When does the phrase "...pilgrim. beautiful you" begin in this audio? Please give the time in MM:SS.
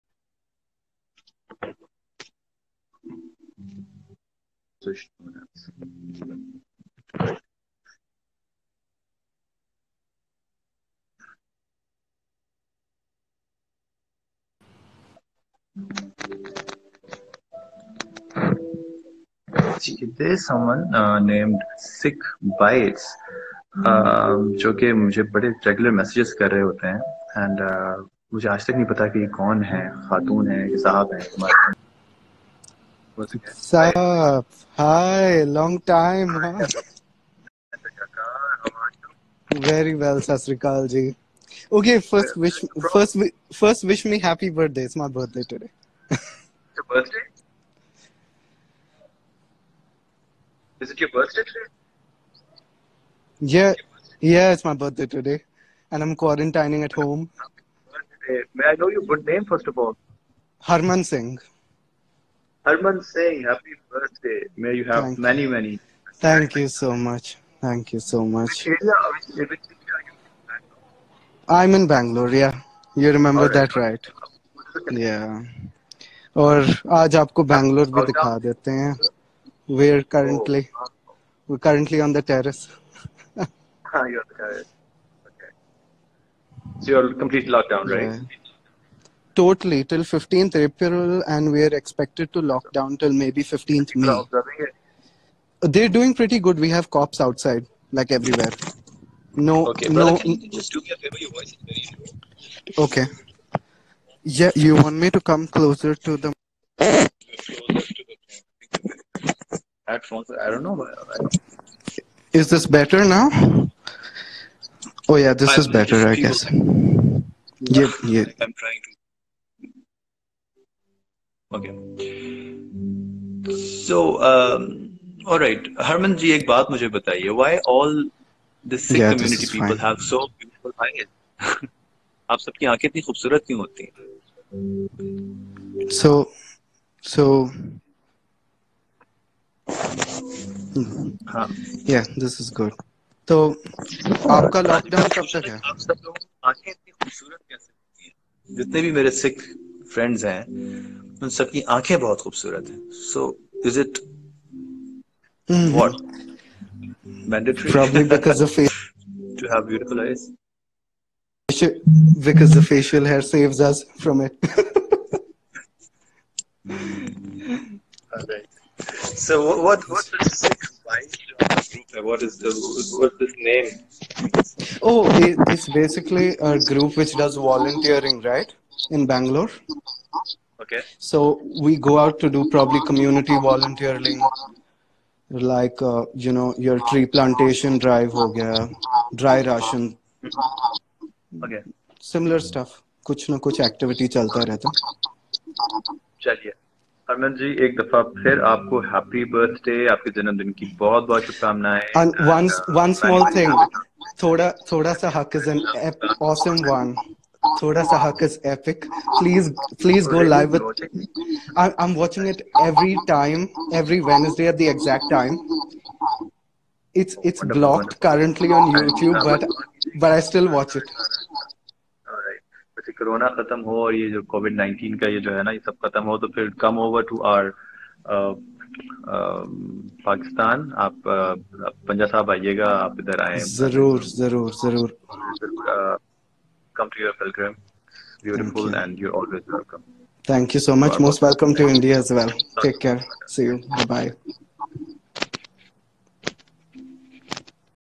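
03:57.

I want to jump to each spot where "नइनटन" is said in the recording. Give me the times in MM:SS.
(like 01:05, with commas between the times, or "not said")
03:44.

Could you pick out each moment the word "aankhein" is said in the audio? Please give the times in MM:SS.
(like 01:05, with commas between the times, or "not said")
02:12.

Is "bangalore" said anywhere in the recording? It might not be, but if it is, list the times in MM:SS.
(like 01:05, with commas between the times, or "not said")
01:11, 02:59.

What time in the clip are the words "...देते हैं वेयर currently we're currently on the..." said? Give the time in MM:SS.
01:18.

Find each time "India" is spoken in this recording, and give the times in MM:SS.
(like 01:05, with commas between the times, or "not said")
04:01.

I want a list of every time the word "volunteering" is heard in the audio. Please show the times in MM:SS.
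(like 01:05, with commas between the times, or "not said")
02:57, 03:03.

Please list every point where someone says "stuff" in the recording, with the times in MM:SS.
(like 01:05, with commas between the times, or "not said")
03:12.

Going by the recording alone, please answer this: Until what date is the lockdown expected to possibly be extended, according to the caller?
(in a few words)
15th May.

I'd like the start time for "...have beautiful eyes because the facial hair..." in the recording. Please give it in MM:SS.
02:39.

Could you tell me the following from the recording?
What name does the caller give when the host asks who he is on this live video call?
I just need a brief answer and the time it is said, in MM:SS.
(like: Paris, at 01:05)
Harman Singh, at 01:00.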